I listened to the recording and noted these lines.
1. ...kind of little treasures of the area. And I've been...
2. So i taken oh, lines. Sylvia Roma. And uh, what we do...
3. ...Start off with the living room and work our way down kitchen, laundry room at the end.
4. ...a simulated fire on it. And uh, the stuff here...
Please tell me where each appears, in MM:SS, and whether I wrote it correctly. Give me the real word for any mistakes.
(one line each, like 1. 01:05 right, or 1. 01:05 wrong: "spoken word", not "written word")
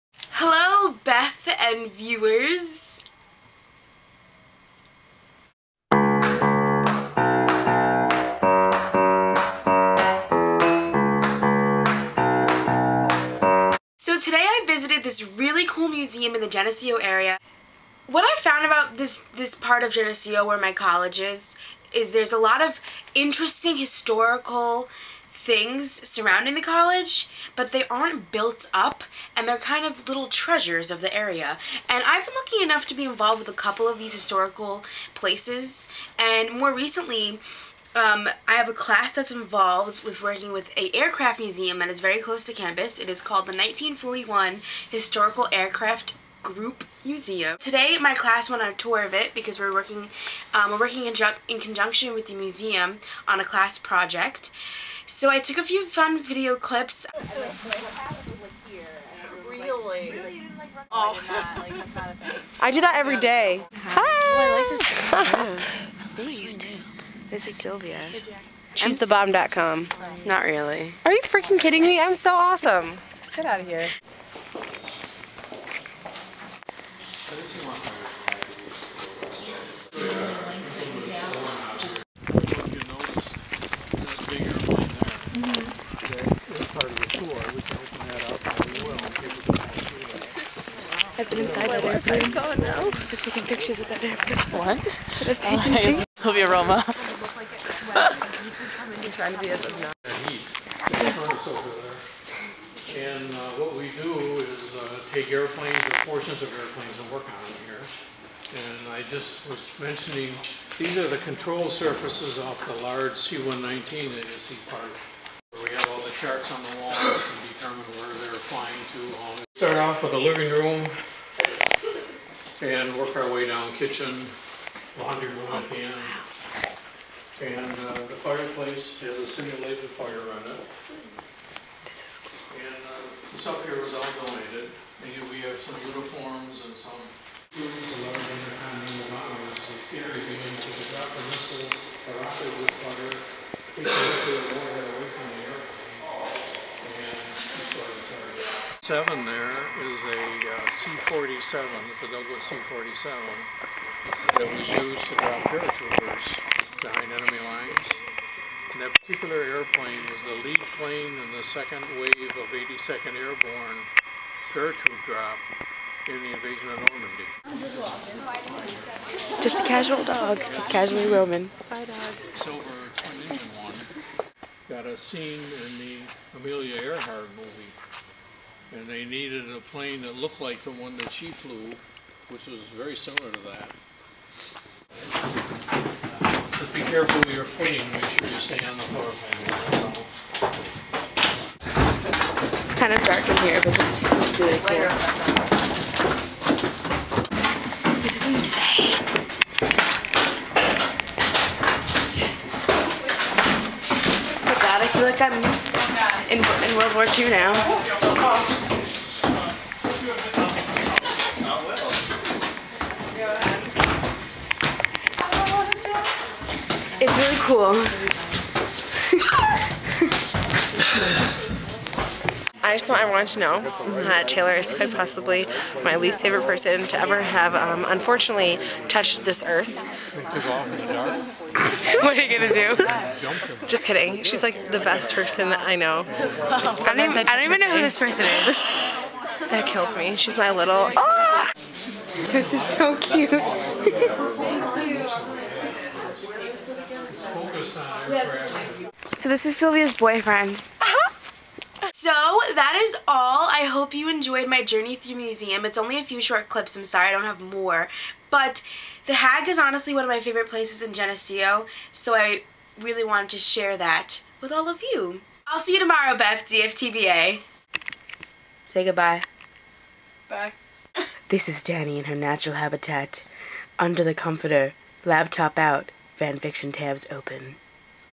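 1. 00:29 right
2. 01:34 wrong: "pictures", not "lines"
3. 01:59 right
4. 02:09 right.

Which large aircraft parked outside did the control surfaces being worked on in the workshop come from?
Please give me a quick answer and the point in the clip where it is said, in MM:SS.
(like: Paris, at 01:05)
C-119, at 01:53.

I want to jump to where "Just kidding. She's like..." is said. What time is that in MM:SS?
03:53.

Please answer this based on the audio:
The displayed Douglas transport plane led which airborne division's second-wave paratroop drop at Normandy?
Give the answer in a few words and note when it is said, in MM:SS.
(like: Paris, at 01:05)
82nd Airborne, at 02:42.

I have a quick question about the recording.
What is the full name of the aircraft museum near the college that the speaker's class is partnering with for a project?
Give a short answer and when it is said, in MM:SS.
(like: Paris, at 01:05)
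1941 Historical Aircraft Group Museum, at 00:43.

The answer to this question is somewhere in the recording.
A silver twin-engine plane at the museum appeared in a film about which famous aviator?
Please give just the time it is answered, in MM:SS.
02:56.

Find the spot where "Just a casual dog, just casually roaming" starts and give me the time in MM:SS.
02:49.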